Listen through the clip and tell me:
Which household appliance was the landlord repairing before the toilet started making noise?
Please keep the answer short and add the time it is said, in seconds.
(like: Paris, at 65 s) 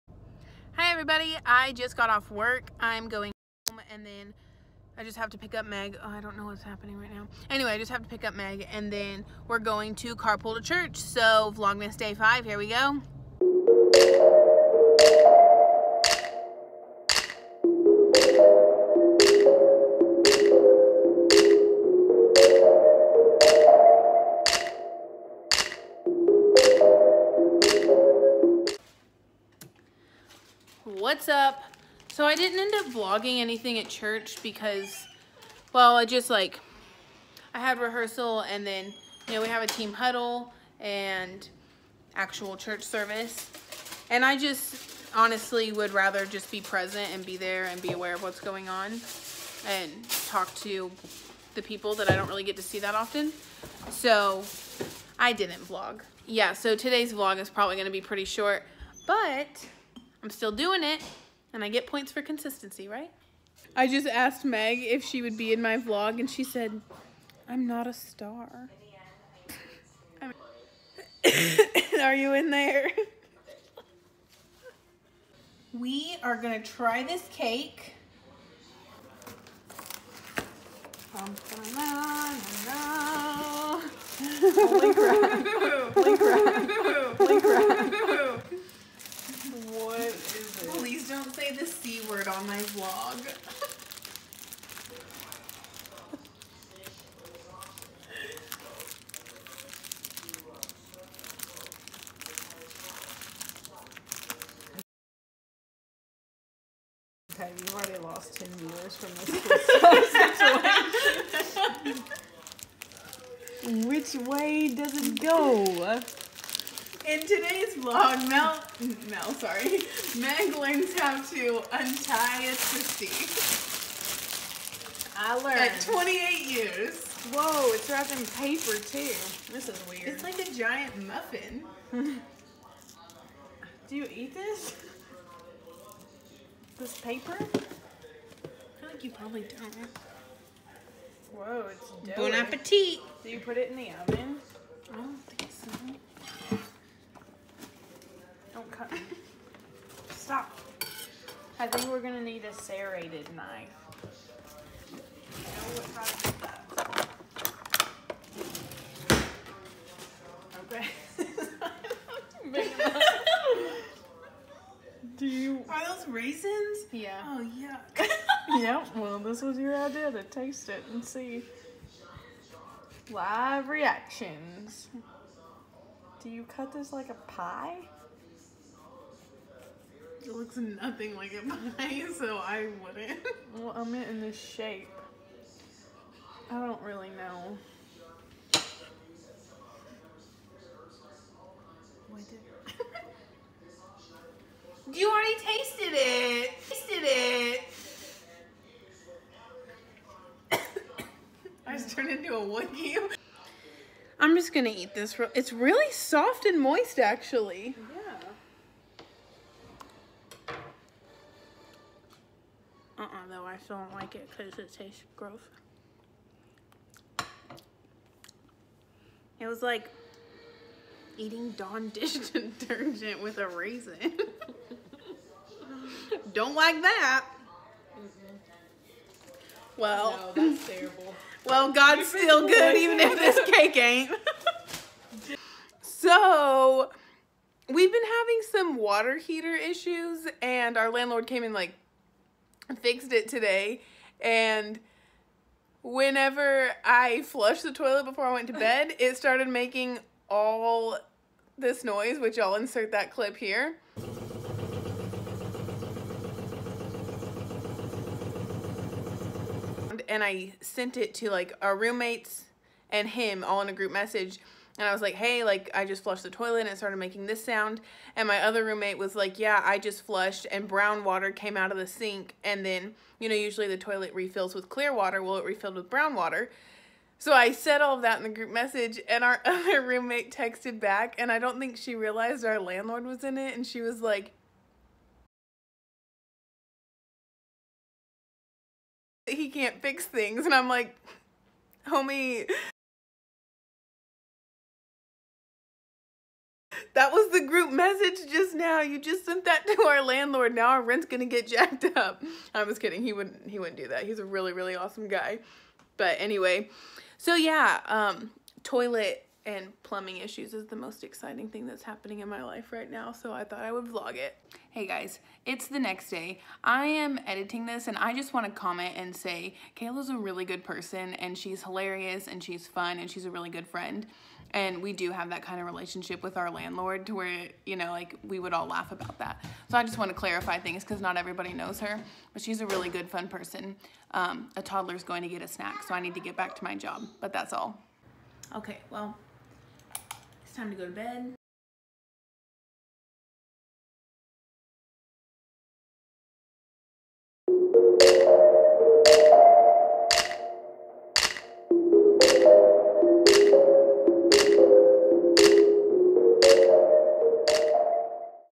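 Water heater, at 238 s.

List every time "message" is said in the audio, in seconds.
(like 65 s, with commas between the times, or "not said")
263 s, 278 s.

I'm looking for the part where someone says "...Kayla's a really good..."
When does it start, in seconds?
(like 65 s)
319 s.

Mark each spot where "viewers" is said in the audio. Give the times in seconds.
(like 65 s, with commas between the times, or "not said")
108 s.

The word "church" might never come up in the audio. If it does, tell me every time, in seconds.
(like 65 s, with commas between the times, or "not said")
10 s, 33 s, 42 s.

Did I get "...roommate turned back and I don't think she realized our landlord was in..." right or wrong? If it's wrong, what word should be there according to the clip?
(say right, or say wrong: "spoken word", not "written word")
wrong: "texted", not "turned".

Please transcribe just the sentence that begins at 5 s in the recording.
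Oh, I don't know what's happening right now.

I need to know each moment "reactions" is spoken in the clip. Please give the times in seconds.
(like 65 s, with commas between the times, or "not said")
173 s.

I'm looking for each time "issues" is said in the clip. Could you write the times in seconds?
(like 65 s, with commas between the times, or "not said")
239 s, 310 s.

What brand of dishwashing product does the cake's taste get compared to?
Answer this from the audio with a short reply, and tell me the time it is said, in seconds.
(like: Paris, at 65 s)
Dawn, at 221 s.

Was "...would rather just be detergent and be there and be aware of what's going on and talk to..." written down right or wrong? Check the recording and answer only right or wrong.
wrong.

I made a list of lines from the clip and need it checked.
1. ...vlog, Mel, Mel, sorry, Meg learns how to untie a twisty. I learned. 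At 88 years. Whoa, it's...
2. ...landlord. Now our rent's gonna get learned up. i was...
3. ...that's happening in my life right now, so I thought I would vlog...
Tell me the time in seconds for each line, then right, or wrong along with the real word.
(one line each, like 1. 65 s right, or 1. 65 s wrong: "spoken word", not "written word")
1. 117 s wrong: "28", not "88"
2. 300 s wrong: "jacked", not "learned"
3. 311 s right.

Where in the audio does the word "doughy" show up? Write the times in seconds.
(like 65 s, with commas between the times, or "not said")
142 s.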